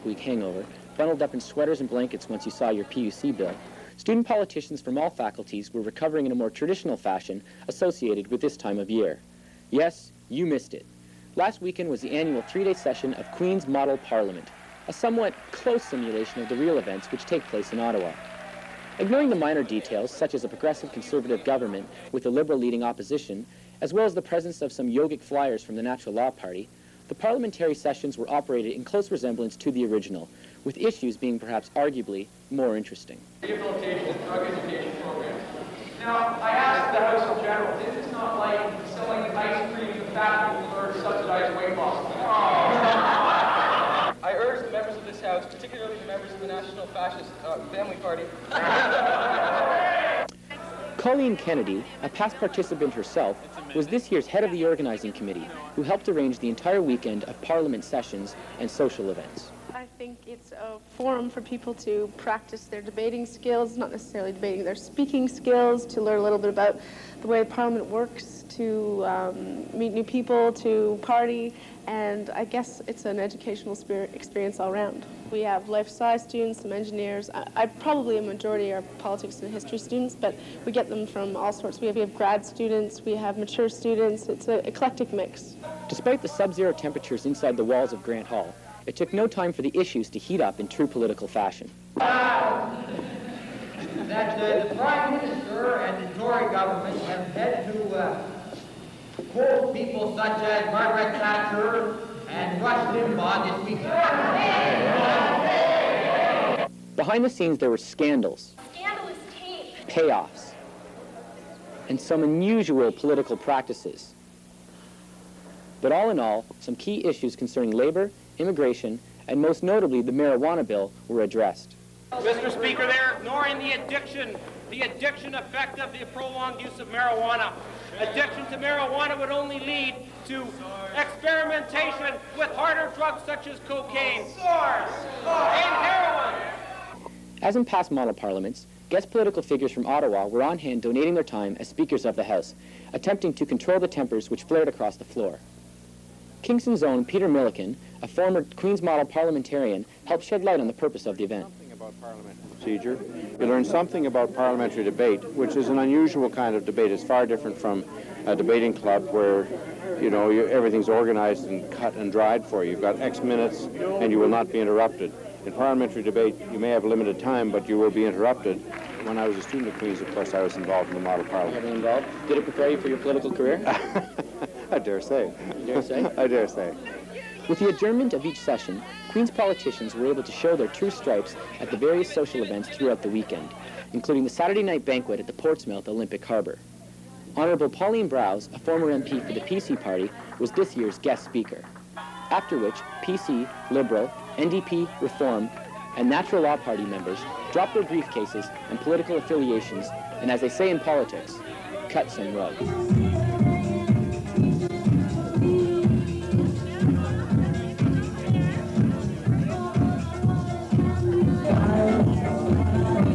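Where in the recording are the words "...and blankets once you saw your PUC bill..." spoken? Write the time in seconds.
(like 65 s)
1 s.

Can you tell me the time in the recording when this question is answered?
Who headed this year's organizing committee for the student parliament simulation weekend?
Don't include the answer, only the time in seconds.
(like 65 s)
50 s.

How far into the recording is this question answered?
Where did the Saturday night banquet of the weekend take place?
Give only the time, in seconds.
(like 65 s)
185 s.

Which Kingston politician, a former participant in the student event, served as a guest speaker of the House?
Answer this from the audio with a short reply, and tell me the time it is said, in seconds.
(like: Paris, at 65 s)
Peter Milliken, at 147 s.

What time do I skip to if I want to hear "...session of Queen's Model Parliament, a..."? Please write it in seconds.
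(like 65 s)
12 s.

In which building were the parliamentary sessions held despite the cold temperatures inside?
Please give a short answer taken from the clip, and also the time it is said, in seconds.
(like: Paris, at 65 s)
Grant Hall, at 88 s.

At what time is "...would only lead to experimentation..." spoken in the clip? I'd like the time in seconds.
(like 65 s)
129 s.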